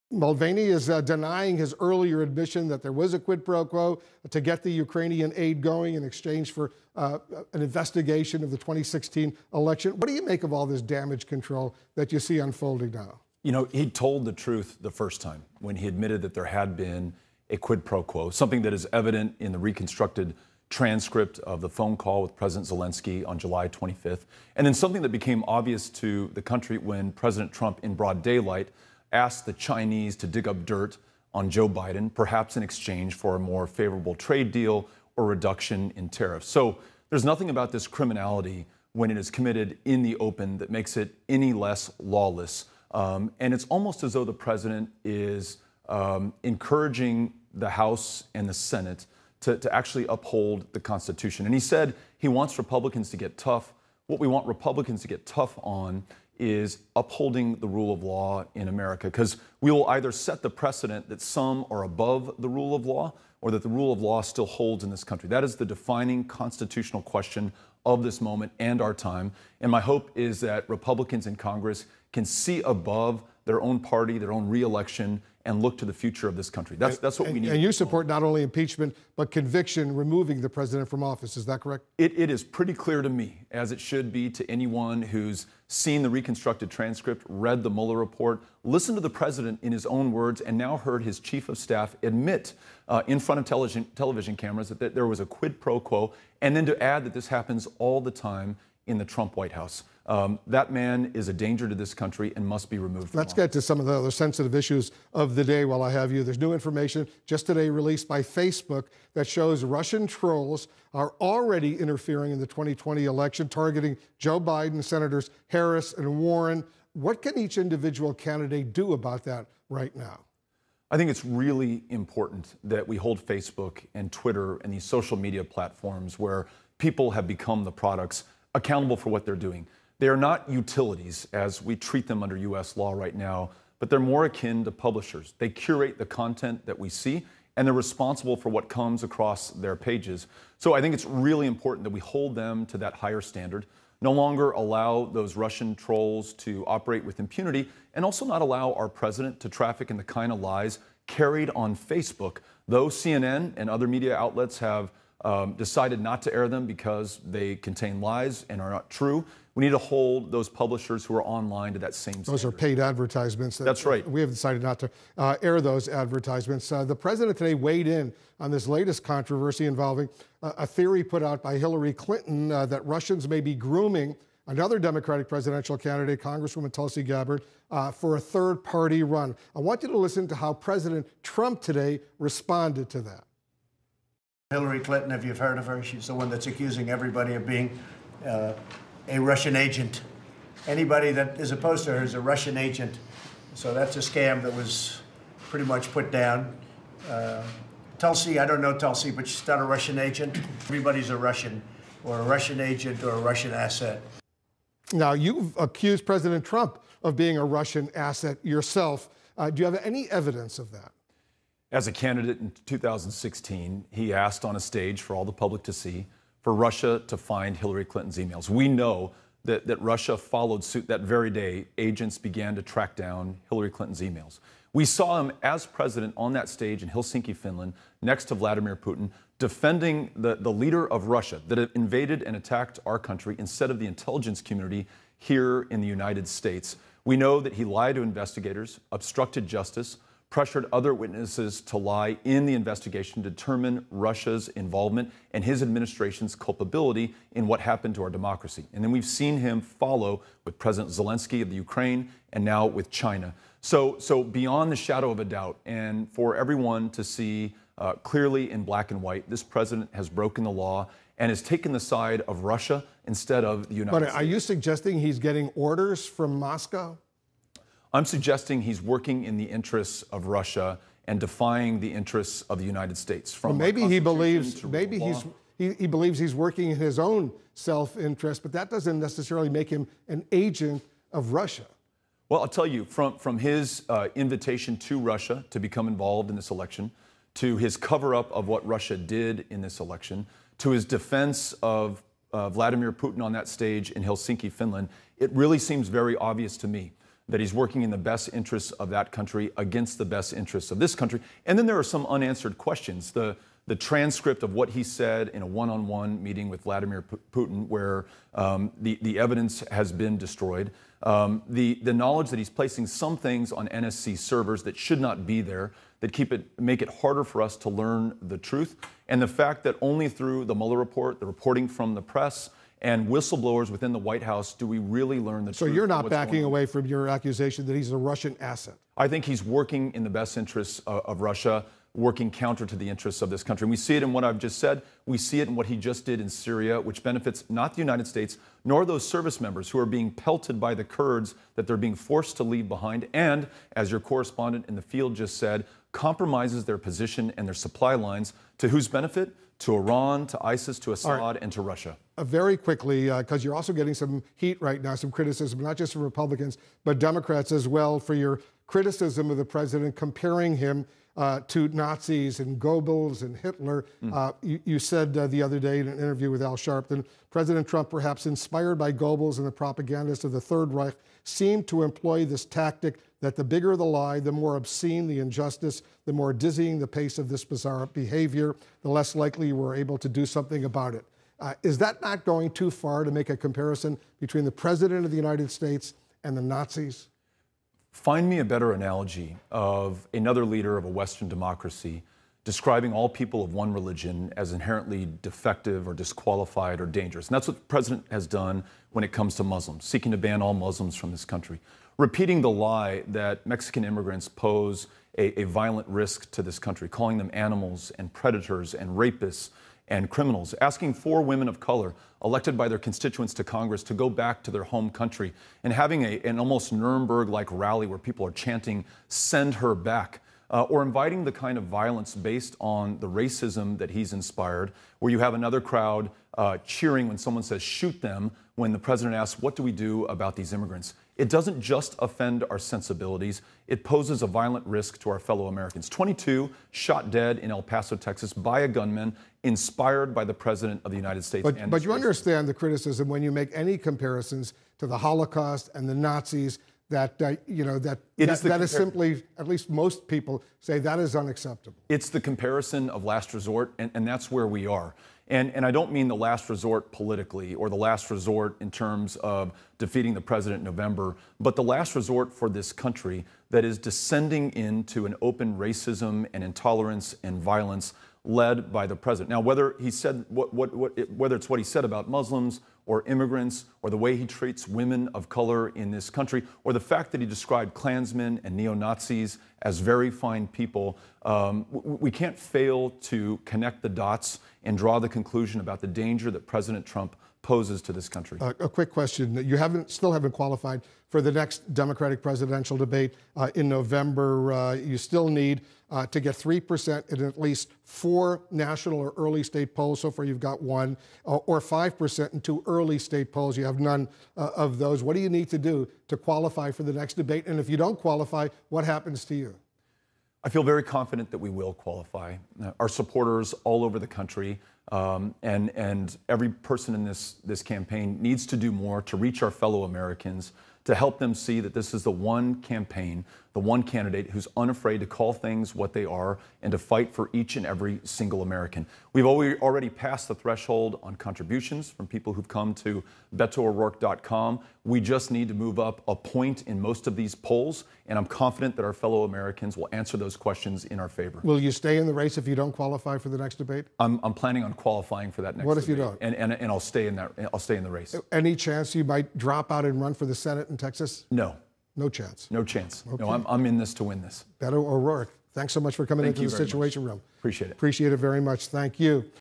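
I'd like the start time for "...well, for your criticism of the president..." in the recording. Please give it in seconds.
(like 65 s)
357 s.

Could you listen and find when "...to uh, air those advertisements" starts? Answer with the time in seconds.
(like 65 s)
164 s.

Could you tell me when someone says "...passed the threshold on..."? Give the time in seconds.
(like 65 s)
529 s.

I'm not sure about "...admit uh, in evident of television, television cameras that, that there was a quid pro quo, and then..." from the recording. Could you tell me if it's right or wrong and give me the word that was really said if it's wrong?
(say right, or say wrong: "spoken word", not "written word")
wrong: "front", not "evident".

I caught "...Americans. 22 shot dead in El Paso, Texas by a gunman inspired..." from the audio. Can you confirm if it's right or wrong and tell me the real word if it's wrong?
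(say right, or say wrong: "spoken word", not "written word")
right.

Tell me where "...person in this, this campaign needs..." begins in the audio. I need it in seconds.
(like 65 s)
516 s.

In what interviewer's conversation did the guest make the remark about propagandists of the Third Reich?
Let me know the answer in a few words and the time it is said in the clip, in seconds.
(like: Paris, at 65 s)
Al Sharpton, at 366 s.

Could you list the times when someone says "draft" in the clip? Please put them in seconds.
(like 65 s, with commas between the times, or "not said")
not said.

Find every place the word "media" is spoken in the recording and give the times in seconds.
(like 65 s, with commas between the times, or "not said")
125 s, 153 s.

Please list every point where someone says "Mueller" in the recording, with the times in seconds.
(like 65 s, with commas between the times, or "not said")
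87 s, 320 s.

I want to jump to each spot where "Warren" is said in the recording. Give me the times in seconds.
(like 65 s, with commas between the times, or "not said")
116 s.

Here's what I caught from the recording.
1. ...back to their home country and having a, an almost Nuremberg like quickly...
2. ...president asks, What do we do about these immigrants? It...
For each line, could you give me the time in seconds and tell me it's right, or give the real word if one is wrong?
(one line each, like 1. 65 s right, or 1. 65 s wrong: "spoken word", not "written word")
1. 414 s wrong: "rally", not "quickly"
2. 428 s right.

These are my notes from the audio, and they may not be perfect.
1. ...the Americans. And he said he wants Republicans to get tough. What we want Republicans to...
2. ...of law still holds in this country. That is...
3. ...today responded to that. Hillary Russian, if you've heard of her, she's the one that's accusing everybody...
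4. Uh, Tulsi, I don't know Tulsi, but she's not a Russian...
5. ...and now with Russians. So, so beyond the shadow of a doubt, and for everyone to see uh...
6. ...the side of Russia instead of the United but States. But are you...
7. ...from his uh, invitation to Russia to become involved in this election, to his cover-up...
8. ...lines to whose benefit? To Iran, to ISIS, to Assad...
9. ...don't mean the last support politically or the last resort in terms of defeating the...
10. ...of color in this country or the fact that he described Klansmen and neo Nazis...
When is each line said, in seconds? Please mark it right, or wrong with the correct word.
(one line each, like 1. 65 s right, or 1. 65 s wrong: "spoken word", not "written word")
1. 50 s wrong: "Constitution", not "Americans"
2. 63 s right
3. 181 s wrong: "Clinton", not "Russian"
4. 197 s right
5. 252 s wrong: "China", not "Russians"
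6. 261 s right
7. 283 s right
8. 347 s right
9. 455 s wrong: "resort", not "support"
10. 475 s right.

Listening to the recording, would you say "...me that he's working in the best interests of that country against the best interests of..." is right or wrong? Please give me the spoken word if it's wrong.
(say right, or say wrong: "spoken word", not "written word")
right.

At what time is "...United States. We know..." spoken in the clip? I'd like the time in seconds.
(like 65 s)
235 s.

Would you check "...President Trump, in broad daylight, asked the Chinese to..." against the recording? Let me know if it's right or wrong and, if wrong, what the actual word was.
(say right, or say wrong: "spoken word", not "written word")
right.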